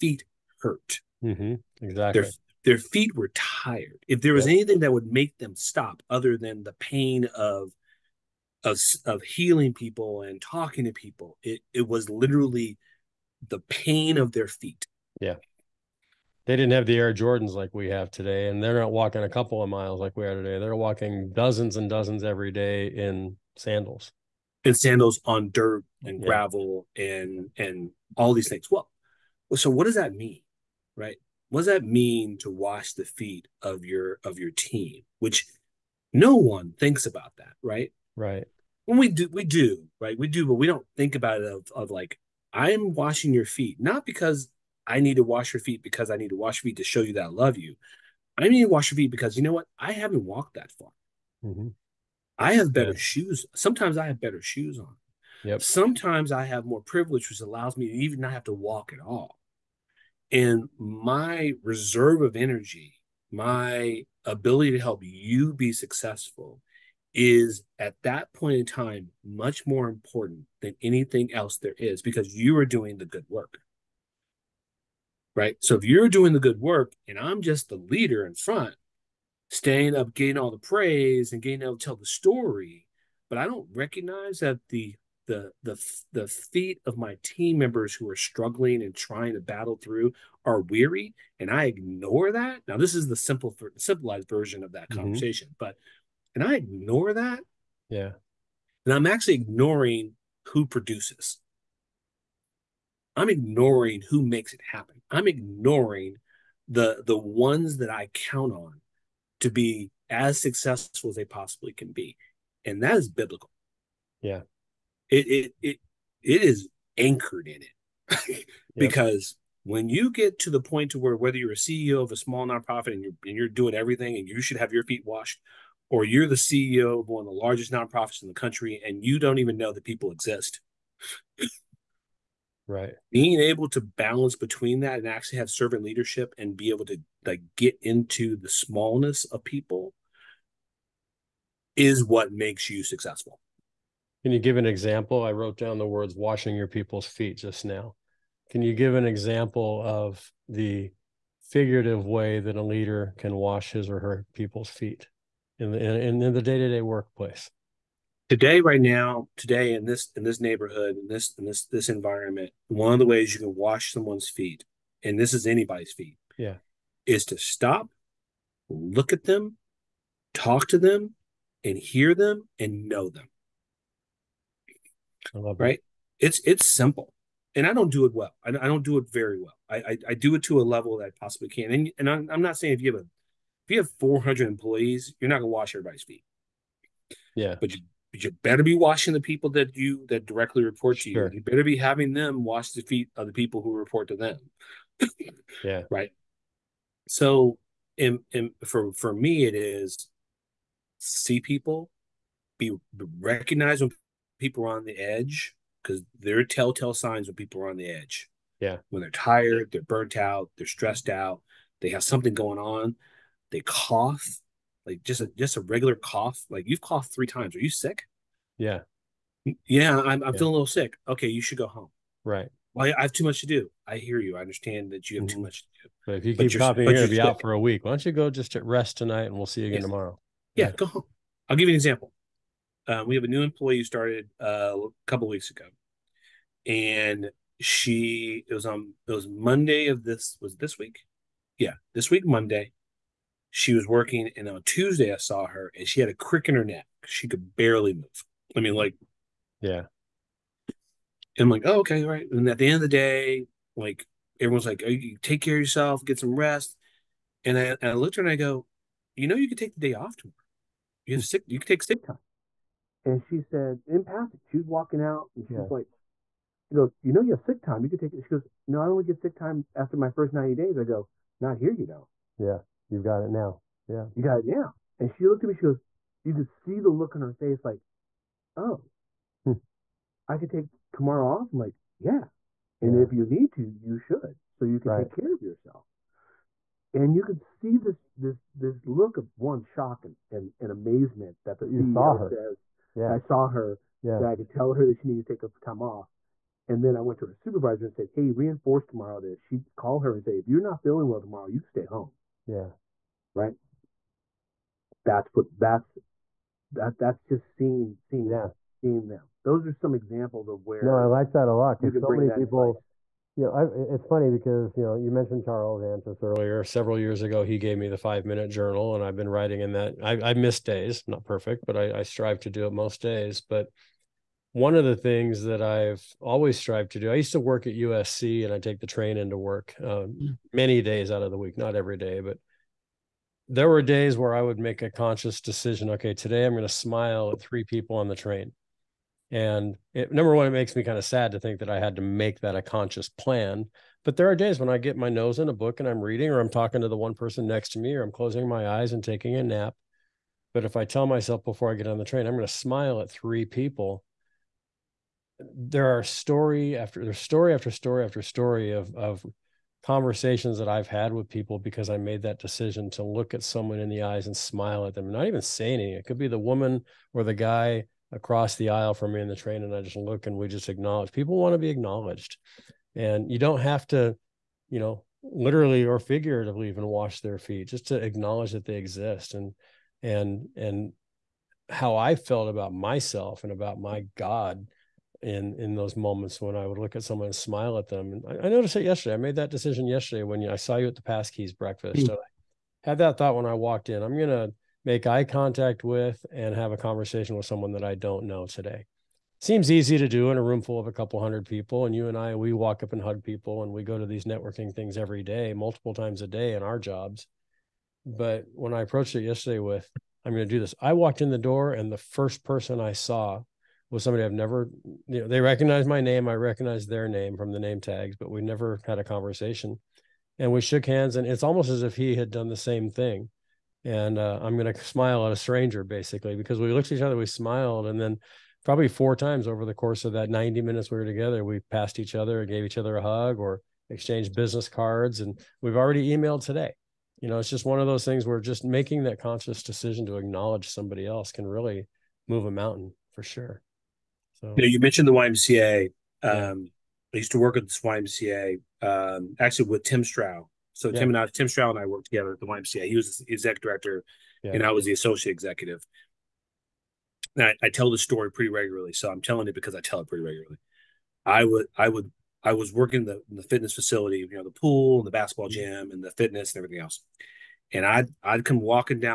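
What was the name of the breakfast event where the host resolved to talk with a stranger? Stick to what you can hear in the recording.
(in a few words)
Pass Keys breakfast.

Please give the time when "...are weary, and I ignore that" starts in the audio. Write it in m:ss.
1:30.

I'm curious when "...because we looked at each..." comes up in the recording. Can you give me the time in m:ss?
7:06.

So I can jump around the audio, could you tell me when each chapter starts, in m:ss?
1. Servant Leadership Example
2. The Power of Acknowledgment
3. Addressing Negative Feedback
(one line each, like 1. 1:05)
1. 2:22
2. 5:08
3. 7:22.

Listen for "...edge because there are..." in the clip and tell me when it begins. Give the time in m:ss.
3:24.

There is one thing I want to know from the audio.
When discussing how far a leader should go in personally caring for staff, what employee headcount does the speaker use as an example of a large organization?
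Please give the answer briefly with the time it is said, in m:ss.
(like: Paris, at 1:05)
400, at 3:04.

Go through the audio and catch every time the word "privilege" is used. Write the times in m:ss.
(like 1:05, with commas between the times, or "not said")
0:56.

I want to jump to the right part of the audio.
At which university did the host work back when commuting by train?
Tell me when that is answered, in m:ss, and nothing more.
5:27.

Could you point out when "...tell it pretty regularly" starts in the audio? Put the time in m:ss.
7:39.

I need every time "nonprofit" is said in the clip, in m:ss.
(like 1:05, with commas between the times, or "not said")
2:02, 2:07.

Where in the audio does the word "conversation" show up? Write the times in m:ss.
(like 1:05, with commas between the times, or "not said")
1:35, 5:59, 6:36, 6:59.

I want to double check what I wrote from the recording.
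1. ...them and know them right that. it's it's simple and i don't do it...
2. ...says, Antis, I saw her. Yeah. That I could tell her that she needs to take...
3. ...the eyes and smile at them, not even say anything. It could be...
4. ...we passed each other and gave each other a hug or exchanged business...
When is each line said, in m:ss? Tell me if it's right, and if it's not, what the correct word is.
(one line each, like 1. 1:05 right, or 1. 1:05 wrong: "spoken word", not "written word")
1. 2:52 right
2. 4:52 wrong: "Yeah", not "Antis"
3. 6:03 right
4. 7:11 right.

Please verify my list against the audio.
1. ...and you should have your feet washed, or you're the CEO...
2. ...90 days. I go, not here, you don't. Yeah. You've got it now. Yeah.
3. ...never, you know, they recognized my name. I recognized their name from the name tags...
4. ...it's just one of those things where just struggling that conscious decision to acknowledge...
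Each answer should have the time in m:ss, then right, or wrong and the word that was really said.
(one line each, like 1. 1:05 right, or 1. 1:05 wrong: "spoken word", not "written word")
1. 2:04 right
2. 4:30 right
3. 6:54 right
4. 7:17 wrong: "making", not "struggling".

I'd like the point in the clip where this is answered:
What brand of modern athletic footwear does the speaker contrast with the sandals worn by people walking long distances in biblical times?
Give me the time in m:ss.
0:16.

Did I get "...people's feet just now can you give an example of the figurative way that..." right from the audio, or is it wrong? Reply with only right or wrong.
right.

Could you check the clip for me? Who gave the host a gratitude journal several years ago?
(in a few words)
Charles Antis.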